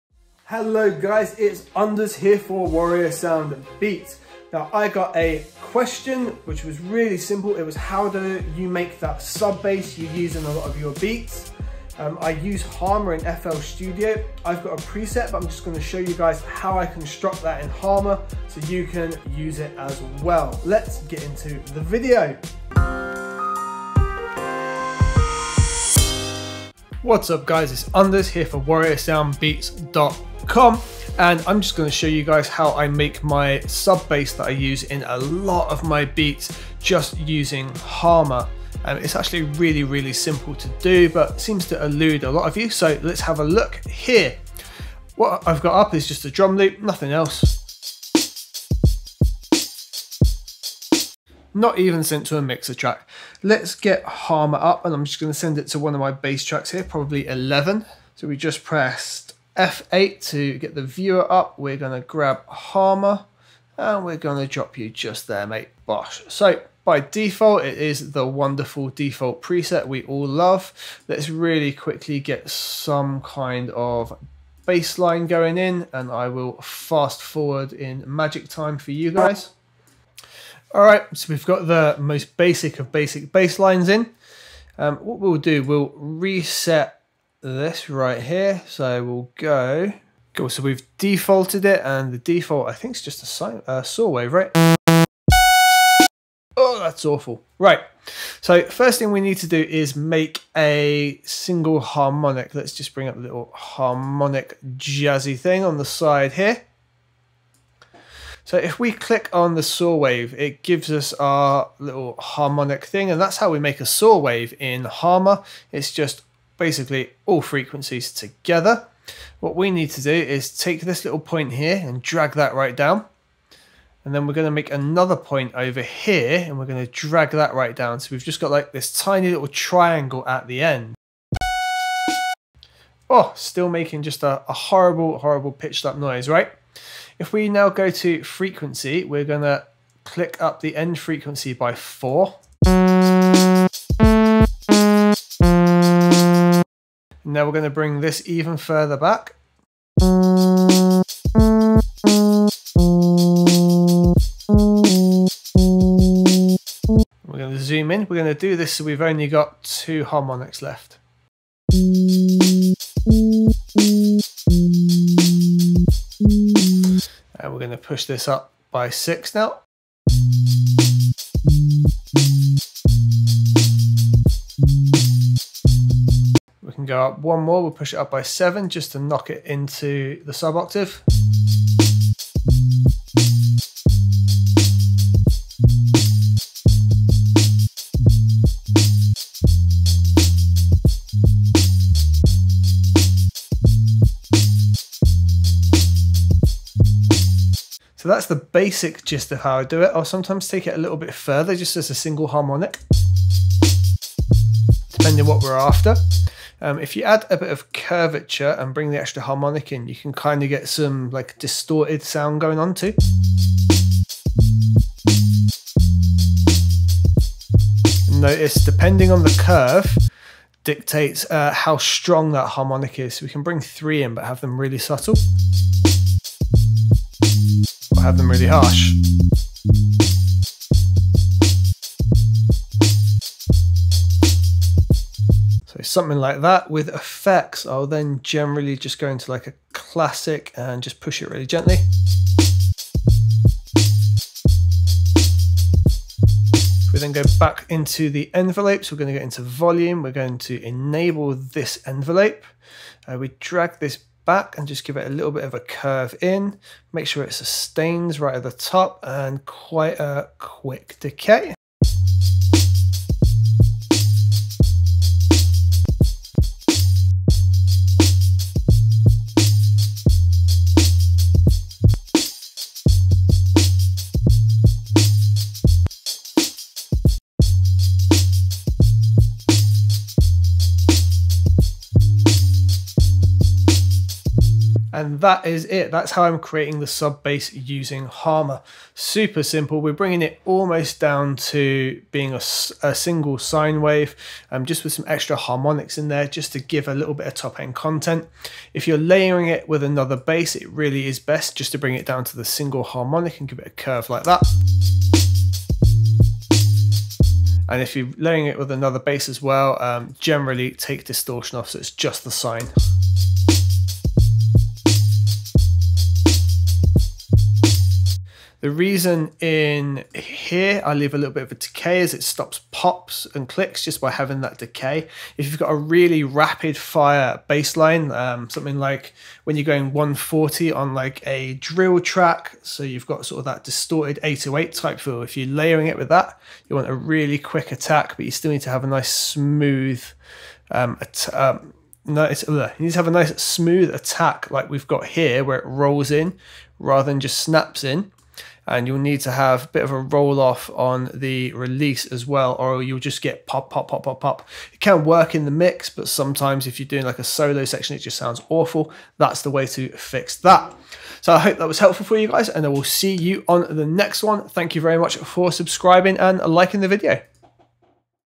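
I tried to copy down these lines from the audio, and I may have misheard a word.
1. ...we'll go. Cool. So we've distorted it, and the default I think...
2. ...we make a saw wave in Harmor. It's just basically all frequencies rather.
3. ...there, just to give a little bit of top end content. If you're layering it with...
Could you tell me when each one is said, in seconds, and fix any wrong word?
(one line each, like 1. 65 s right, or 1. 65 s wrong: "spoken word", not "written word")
1. 89 s wrong: "defaulted", not "distorted"
2. 113 s wrong: "together", not "rather"
3. 296 s right.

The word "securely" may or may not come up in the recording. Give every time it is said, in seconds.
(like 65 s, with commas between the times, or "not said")
not said.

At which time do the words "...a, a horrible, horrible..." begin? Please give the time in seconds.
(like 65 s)
134 s.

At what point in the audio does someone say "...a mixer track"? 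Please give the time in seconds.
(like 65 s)
52 s.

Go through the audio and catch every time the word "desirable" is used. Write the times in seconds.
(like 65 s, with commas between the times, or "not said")
not said.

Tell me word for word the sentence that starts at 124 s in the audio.
And then we're going to make another point over here and we're going to drag that right down.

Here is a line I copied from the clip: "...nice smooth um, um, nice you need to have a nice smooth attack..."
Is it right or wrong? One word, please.
right.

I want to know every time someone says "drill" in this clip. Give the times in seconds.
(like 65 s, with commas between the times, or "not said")
331 s.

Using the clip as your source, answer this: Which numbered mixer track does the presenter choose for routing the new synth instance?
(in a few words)
11.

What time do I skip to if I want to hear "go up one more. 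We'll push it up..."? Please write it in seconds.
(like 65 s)
176 s.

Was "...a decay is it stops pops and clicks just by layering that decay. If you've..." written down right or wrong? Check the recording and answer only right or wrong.
wrong.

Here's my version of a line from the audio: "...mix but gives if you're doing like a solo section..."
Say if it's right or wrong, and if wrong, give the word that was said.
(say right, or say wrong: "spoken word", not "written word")
wrong: "sometimes", not "gives".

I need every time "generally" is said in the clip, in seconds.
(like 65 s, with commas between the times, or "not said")
238 s, 310 s.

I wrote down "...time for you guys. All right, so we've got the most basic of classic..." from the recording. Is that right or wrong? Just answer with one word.
wrong.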